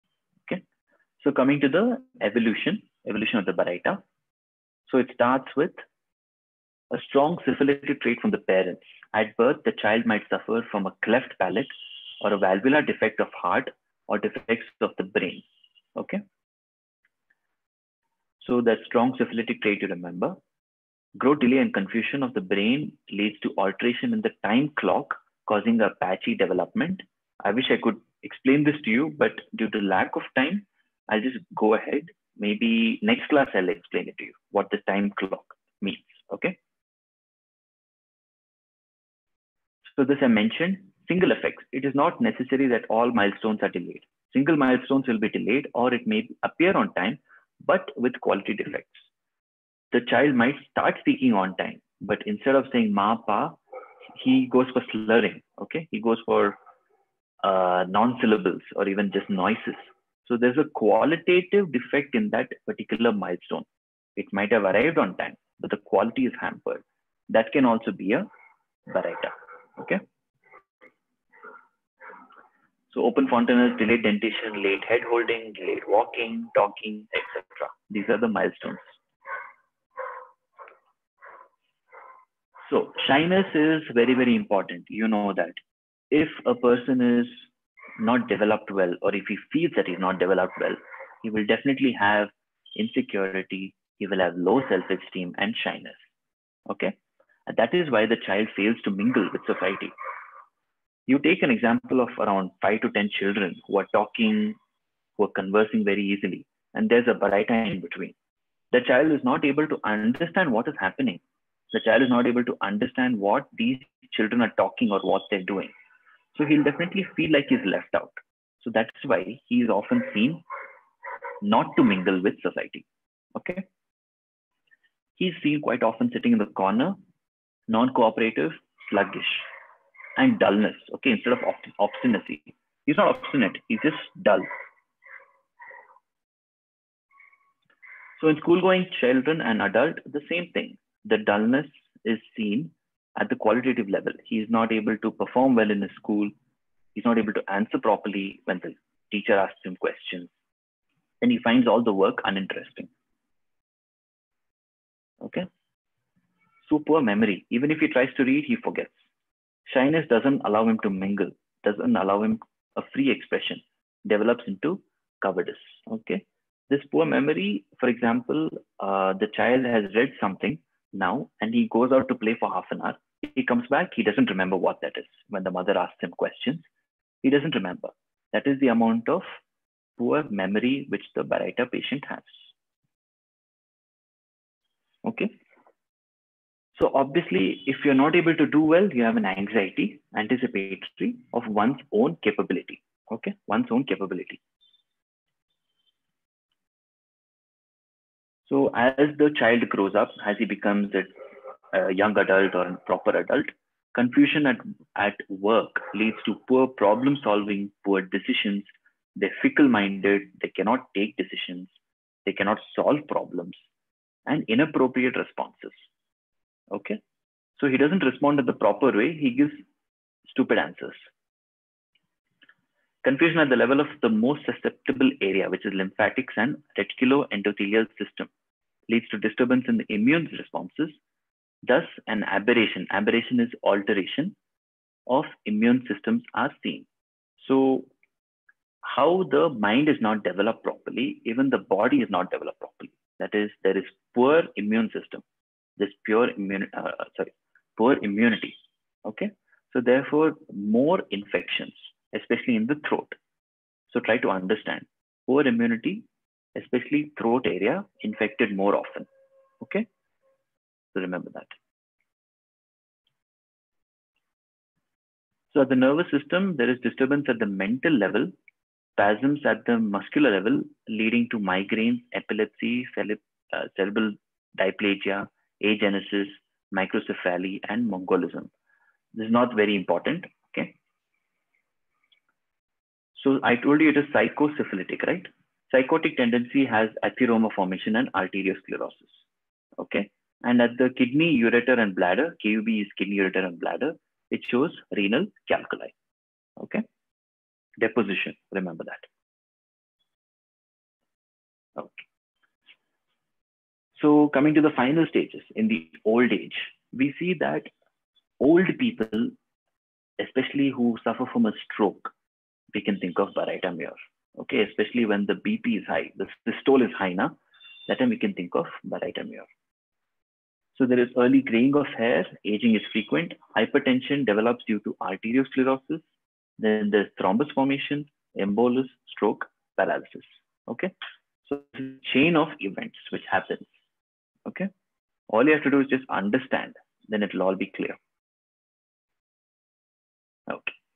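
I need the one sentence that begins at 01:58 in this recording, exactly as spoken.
So that's why he is often seen not to mingle with society.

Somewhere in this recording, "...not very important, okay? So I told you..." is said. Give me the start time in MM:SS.
04:39.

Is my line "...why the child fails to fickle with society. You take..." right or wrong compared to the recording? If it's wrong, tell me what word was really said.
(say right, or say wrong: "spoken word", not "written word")
wrong: "mingle", not "fickle".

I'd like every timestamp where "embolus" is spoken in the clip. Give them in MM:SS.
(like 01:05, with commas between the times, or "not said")
05:28.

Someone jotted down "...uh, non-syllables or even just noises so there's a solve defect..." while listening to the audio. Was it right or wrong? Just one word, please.
wrong.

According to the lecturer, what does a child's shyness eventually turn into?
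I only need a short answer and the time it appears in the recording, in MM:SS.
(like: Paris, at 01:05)
cowardice, at 02:45.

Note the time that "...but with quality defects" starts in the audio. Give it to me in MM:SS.
00:47.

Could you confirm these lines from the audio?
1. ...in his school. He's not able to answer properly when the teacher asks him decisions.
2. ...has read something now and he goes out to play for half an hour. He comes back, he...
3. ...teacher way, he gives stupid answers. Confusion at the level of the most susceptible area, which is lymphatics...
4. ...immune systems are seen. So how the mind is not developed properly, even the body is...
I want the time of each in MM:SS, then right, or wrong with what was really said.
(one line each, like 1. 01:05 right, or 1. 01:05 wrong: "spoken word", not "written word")
1. 02:25 wrong: "questions", not "decisions"
2. 02:49 right
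3. 03:38 wrong: "proper", not "teacher"
4. 03:55 right.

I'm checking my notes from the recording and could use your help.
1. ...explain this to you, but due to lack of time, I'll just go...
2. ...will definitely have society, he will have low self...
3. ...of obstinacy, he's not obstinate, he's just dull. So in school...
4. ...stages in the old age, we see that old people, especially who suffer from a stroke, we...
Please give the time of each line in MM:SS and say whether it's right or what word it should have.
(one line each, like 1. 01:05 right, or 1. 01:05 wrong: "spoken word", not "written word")
1. 00:28 right
2. 01:31 wrong: "insecurity", not "society"
3. 02:11 right
4. 05:05 right.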